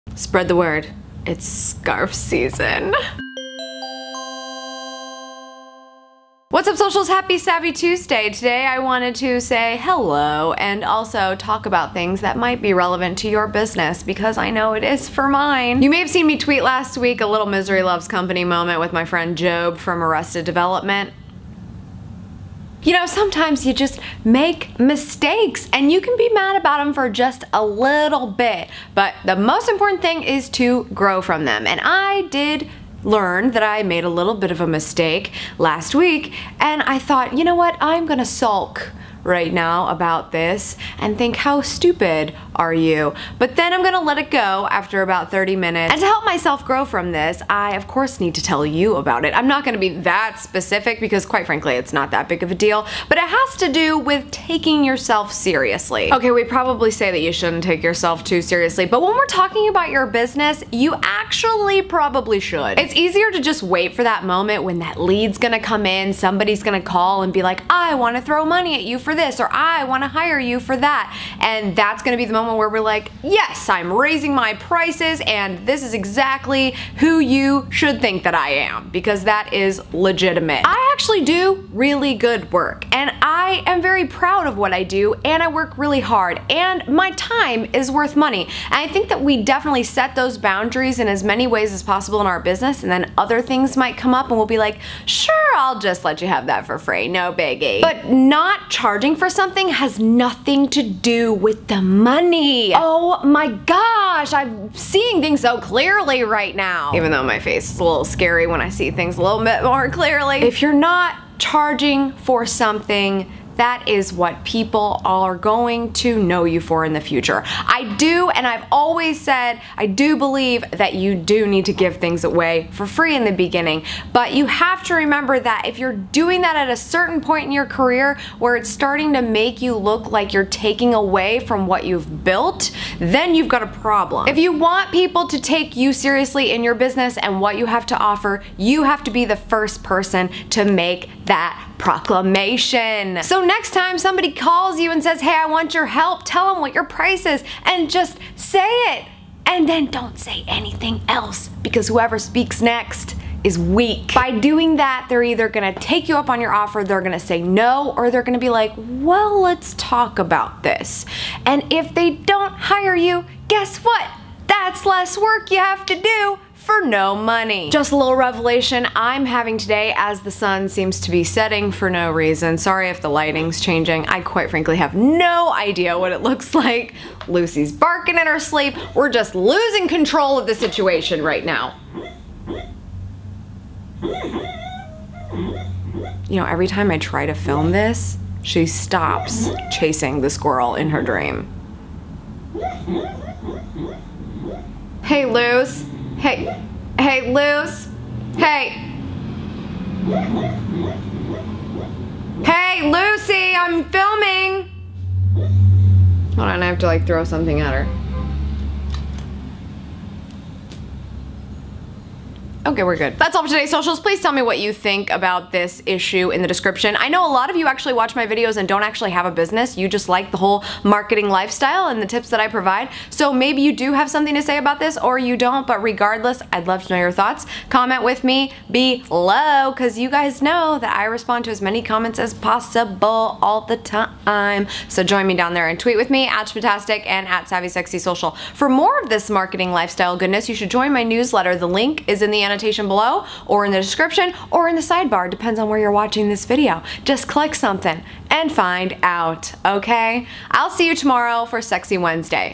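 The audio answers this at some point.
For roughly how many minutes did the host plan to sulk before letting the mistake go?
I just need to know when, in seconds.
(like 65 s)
45 s.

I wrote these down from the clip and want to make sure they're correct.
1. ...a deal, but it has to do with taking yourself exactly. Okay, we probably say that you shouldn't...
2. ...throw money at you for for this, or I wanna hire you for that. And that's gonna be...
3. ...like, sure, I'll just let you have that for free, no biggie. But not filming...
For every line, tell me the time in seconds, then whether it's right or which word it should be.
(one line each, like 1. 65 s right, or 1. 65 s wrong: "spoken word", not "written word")
1. 52 s wrong: "seriously", not "exactly"
2. 68 s right
3. 94 s wrong: "charging", not "filming".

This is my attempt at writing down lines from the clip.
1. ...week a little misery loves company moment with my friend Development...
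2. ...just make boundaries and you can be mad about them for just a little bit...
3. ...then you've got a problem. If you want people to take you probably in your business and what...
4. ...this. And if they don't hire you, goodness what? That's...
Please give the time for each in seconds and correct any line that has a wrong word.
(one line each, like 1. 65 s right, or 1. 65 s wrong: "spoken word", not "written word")
1. 16 s wrong: "GOB", not "Development"
2. 23 s wrong: "mistakes", not "boundaries"
3. 132 s wrong: "seriously", not "probably"
4. 160 s wrong: "guess", not "goodness".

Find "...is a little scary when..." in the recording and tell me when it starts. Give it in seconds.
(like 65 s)
107 s.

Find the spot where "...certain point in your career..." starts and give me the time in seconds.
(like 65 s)
126 s.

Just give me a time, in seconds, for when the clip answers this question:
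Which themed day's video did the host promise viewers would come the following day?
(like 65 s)
251 s.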